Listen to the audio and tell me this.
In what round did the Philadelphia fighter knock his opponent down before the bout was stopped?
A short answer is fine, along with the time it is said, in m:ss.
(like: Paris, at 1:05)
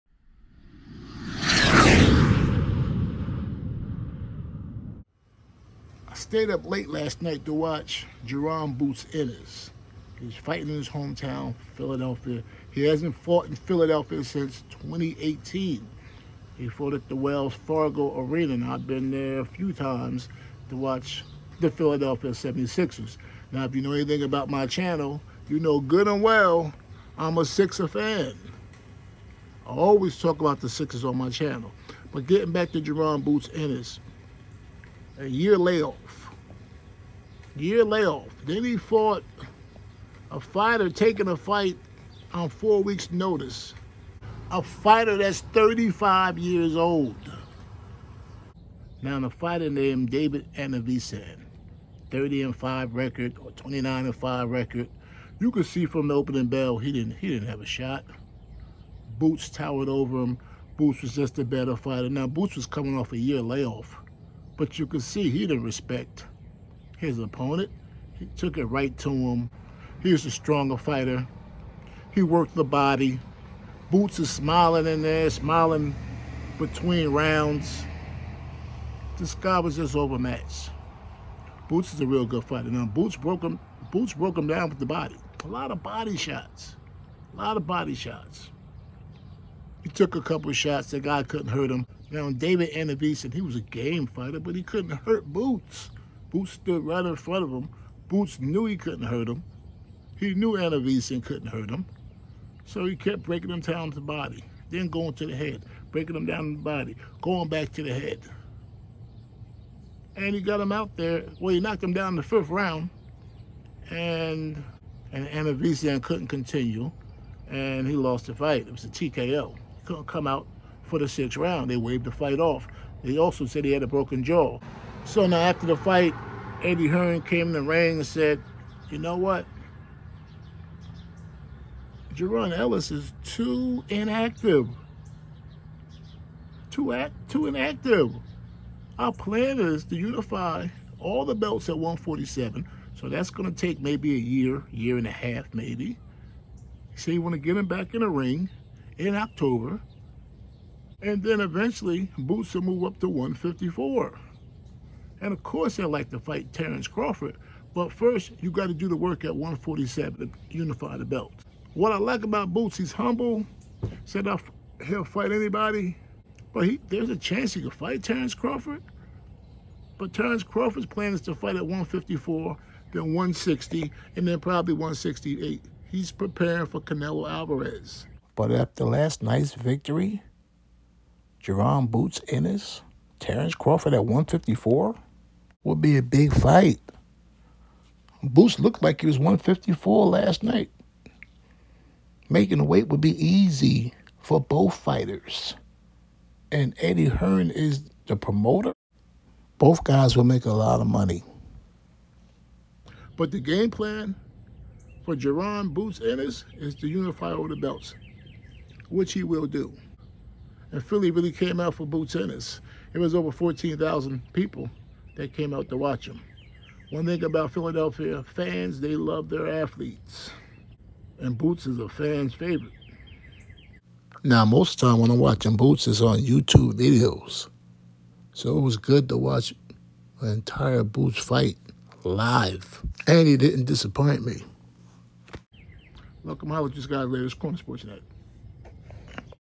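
fifth round, at 1:52.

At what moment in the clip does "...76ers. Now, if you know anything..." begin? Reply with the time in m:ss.
0:22.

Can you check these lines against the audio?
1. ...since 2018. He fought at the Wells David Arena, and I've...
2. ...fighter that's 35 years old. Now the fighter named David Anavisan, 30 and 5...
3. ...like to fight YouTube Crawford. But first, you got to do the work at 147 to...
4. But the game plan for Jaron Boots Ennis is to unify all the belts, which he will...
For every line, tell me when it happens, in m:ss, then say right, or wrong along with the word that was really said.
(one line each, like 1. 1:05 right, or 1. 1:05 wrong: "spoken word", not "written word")
1. 0:14 wrong: "Fargo", not "David"
2. 0:44 right
3. 2:35 wrong: "Terrence", not "YouTube"
4. 3:23 right.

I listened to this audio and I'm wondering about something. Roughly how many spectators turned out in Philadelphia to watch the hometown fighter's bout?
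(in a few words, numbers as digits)
over 14,000.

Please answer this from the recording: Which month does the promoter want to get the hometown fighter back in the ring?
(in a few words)
October.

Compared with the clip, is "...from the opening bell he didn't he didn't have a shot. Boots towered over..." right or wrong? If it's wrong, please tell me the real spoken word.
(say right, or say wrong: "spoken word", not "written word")
right.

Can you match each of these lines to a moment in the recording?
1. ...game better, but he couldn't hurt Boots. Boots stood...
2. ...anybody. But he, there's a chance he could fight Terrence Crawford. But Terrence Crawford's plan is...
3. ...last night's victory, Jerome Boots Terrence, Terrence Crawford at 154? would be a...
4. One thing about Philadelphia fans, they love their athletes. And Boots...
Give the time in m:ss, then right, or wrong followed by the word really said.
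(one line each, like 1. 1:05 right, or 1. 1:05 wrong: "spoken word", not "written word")
1. 1:33 wrong: "fighter", not "better"
2. 2:45 right
3. 2:58 wrong: "Ennis", not "Terrence"
4. 3:36 right.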